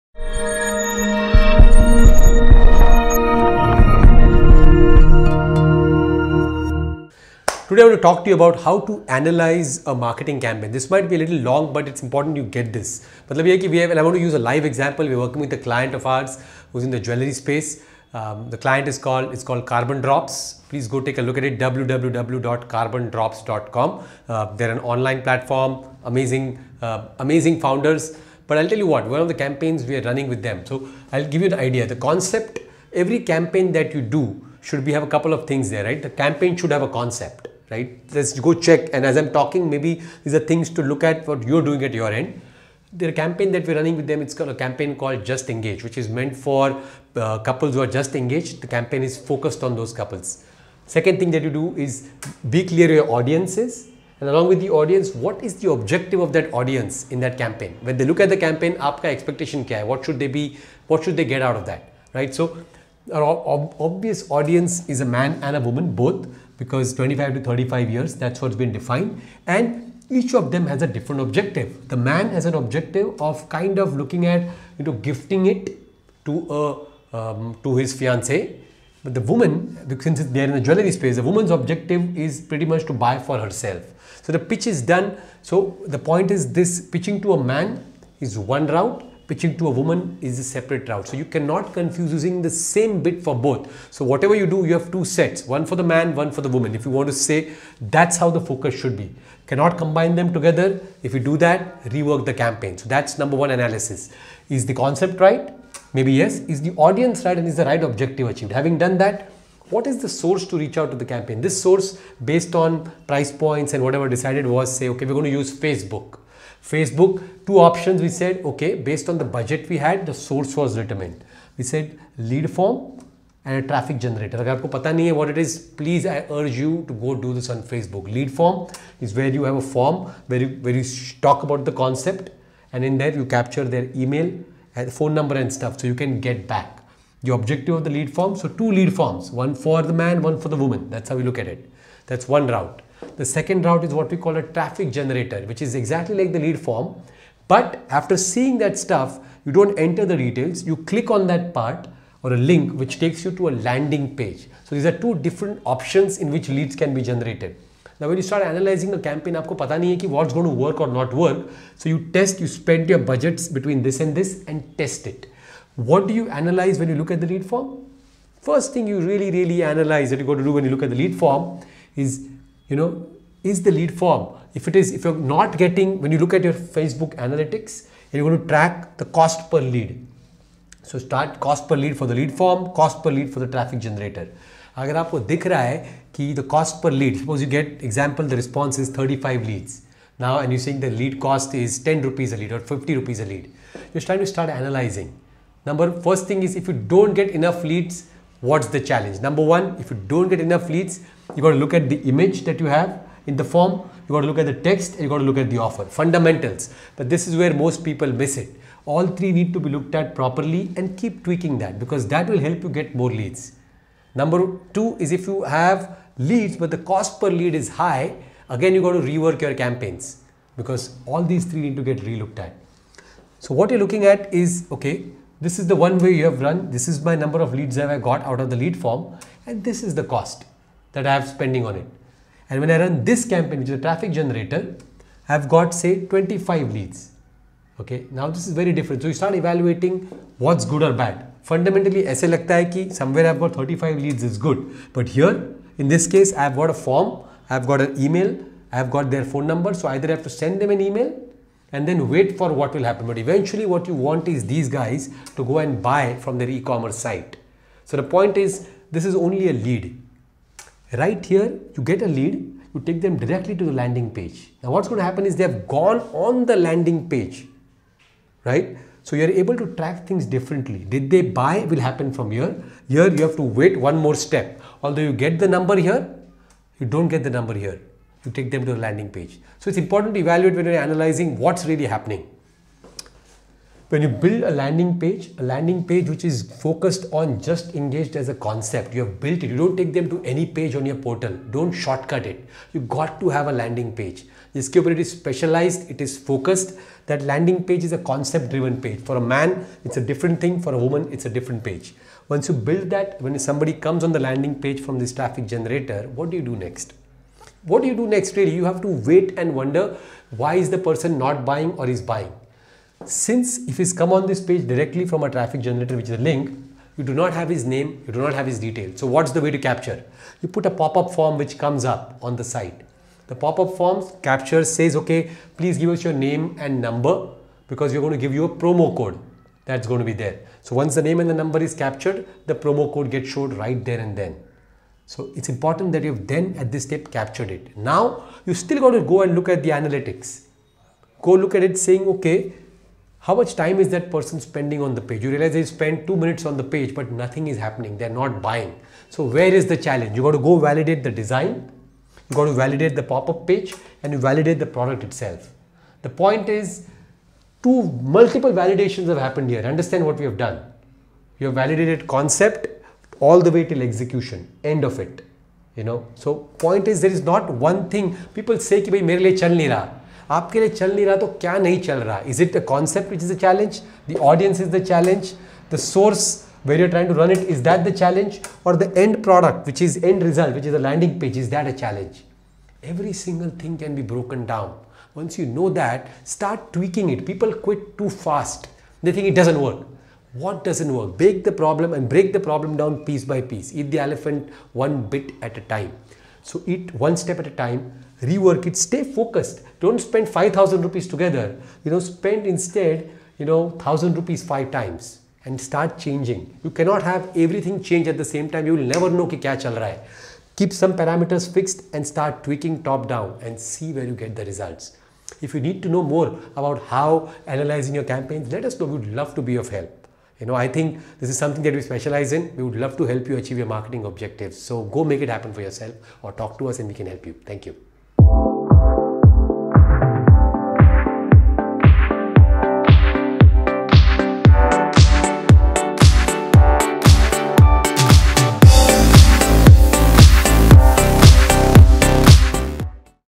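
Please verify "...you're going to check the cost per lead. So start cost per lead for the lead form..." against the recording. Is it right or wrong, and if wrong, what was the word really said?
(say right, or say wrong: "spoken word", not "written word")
wrong: "track", not "check".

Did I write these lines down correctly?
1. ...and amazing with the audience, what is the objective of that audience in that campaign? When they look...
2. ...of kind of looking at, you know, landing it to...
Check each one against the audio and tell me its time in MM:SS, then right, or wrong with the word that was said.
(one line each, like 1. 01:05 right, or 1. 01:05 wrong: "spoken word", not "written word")
1. 00:54 wrong: "along", not "amazing"
2. 01:13 wrong: "gifting", not "landing".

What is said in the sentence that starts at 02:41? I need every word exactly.
So you test, you spend your budgets between this and this and test it.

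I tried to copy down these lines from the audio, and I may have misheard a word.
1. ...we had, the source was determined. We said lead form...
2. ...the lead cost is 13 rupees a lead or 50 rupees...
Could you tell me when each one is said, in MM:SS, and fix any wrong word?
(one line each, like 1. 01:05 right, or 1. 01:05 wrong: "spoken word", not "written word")
1. 01:59 right
2. 03:10 wrong: "10", not "13".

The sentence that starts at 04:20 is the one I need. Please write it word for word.
Right here, you get a lead, you take them directly to the landing page.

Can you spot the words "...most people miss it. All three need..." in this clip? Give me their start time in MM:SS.
03:27.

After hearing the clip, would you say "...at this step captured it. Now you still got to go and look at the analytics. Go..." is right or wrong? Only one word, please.
right.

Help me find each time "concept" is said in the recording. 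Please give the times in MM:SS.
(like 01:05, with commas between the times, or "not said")
00:31, 00:36, 01:44, 02:11, 04:48, 04:57, 06:02, 06:12.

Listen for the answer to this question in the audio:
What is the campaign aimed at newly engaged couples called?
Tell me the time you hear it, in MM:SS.
00:45.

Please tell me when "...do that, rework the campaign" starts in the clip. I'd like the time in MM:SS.
01:41.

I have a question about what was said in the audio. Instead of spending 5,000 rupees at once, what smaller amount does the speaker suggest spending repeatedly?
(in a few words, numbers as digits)
1,000 rupees.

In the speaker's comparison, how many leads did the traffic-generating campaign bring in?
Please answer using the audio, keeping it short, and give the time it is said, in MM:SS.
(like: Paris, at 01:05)
25, at 03:56.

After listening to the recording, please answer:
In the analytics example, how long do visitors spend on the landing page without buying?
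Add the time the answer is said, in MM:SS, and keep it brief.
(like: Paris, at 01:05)
two minutes, at 05:46.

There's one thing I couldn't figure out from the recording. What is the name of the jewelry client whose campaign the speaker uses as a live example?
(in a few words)
Carbon Drops.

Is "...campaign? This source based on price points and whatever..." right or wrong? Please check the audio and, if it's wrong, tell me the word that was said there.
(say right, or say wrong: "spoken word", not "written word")
right.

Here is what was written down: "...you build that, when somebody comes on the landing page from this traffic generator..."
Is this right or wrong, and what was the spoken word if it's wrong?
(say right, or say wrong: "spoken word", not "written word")
right.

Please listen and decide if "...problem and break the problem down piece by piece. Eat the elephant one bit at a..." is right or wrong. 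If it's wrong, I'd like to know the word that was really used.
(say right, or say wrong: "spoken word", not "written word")
right.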